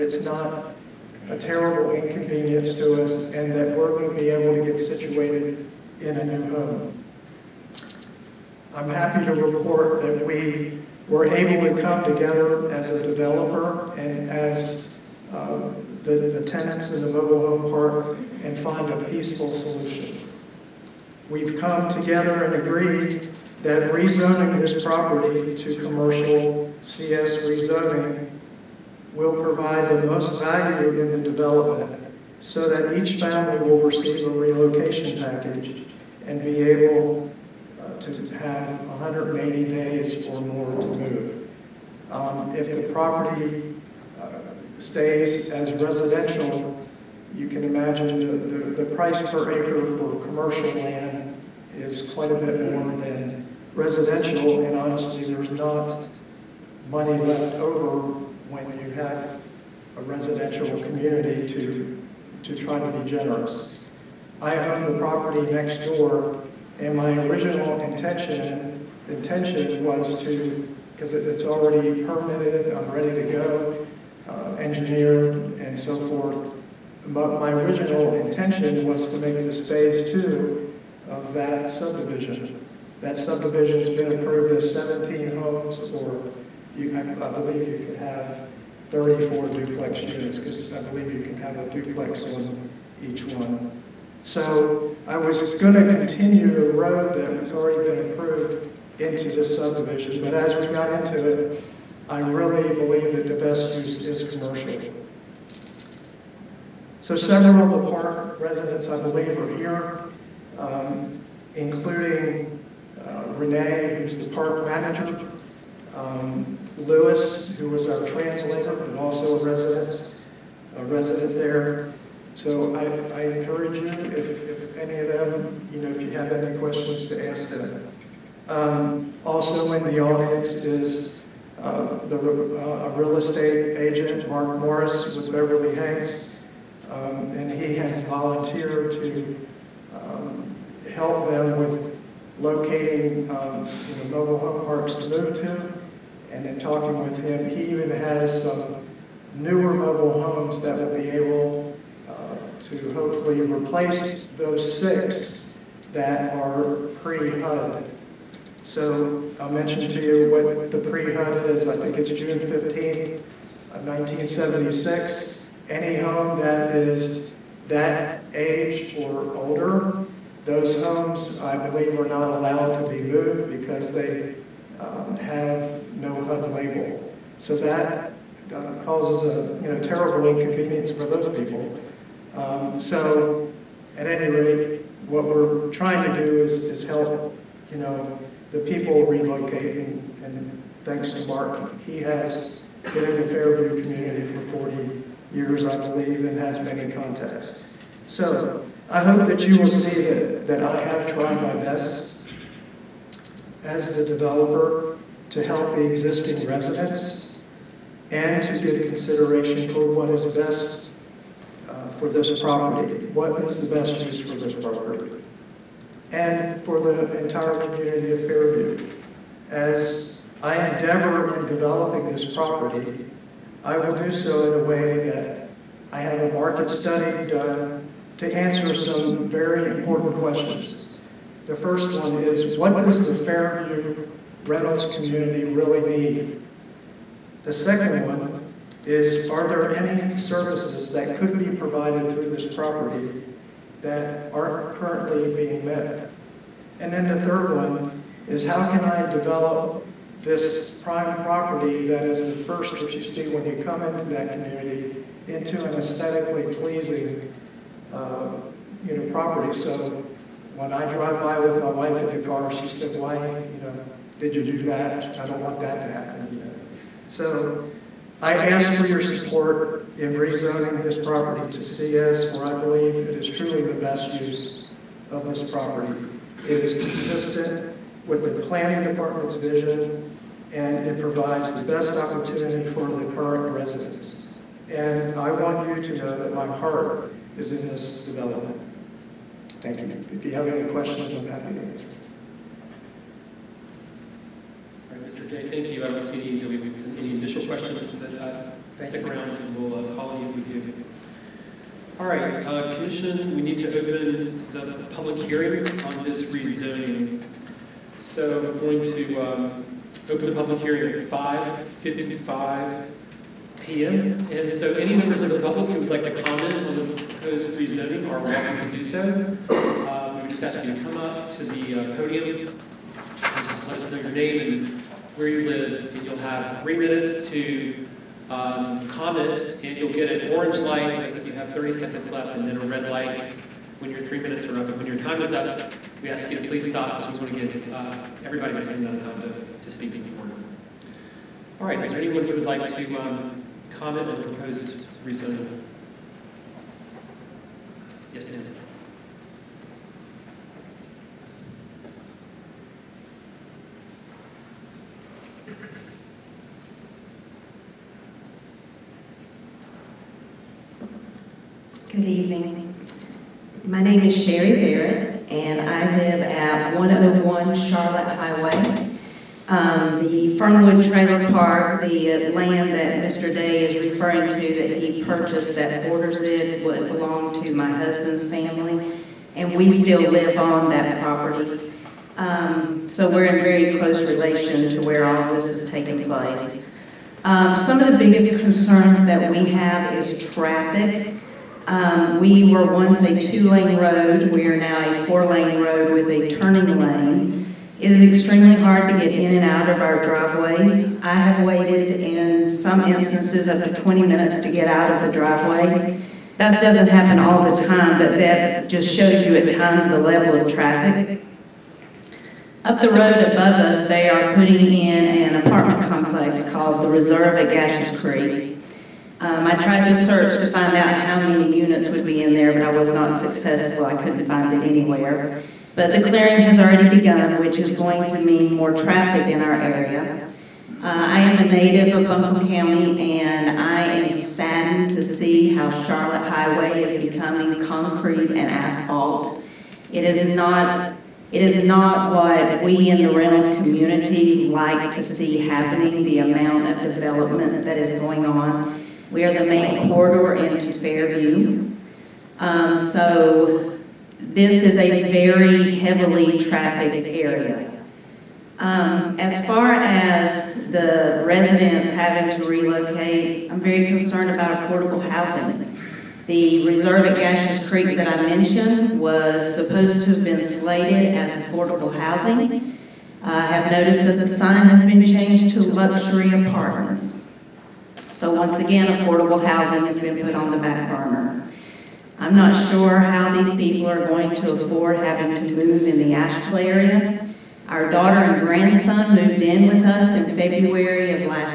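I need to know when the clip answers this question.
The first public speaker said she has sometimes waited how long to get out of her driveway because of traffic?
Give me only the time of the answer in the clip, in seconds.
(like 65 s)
403 s.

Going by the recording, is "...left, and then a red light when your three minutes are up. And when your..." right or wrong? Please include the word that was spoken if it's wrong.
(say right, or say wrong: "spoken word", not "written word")
right.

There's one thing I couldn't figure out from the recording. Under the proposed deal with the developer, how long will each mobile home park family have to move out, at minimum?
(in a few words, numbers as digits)
180 days.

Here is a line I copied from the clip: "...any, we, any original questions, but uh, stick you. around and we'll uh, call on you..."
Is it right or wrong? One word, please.
wrong.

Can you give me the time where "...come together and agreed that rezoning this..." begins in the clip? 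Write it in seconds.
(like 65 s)
21 s.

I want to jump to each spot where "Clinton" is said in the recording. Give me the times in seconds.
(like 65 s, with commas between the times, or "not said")
not said.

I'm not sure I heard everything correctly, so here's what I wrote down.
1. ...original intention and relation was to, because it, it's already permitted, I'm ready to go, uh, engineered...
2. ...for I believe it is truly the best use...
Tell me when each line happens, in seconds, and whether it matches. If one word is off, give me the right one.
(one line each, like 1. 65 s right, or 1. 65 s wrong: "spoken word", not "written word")
1. 67 s wrong: "intention", not "relation"
2. 272 s right.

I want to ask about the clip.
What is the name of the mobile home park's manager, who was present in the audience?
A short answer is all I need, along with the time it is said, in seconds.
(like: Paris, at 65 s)
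Renee, at 113 s.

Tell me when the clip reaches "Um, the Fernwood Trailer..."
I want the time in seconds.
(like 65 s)
369 s.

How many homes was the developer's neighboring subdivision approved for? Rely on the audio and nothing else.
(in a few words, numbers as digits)
17.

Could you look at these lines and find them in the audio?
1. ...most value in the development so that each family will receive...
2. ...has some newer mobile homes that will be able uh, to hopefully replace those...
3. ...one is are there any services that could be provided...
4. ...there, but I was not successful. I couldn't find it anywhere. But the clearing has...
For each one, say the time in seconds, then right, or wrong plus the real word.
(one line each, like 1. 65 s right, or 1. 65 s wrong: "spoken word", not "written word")
1. 30 s right
2. 147 s right
3. 238 s right
4. 422 s right.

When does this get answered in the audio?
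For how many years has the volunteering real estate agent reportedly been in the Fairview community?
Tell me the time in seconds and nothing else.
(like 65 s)
194 s.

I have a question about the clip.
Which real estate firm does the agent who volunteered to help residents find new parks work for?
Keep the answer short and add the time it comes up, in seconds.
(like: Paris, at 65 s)
Beverly Hanks, at 135 s.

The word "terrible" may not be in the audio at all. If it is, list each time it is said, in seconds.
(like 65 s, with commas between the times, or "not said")
1 s, 179 s.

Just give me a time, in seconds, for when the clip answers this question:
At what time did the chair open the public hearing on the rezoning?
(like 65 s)
310 s.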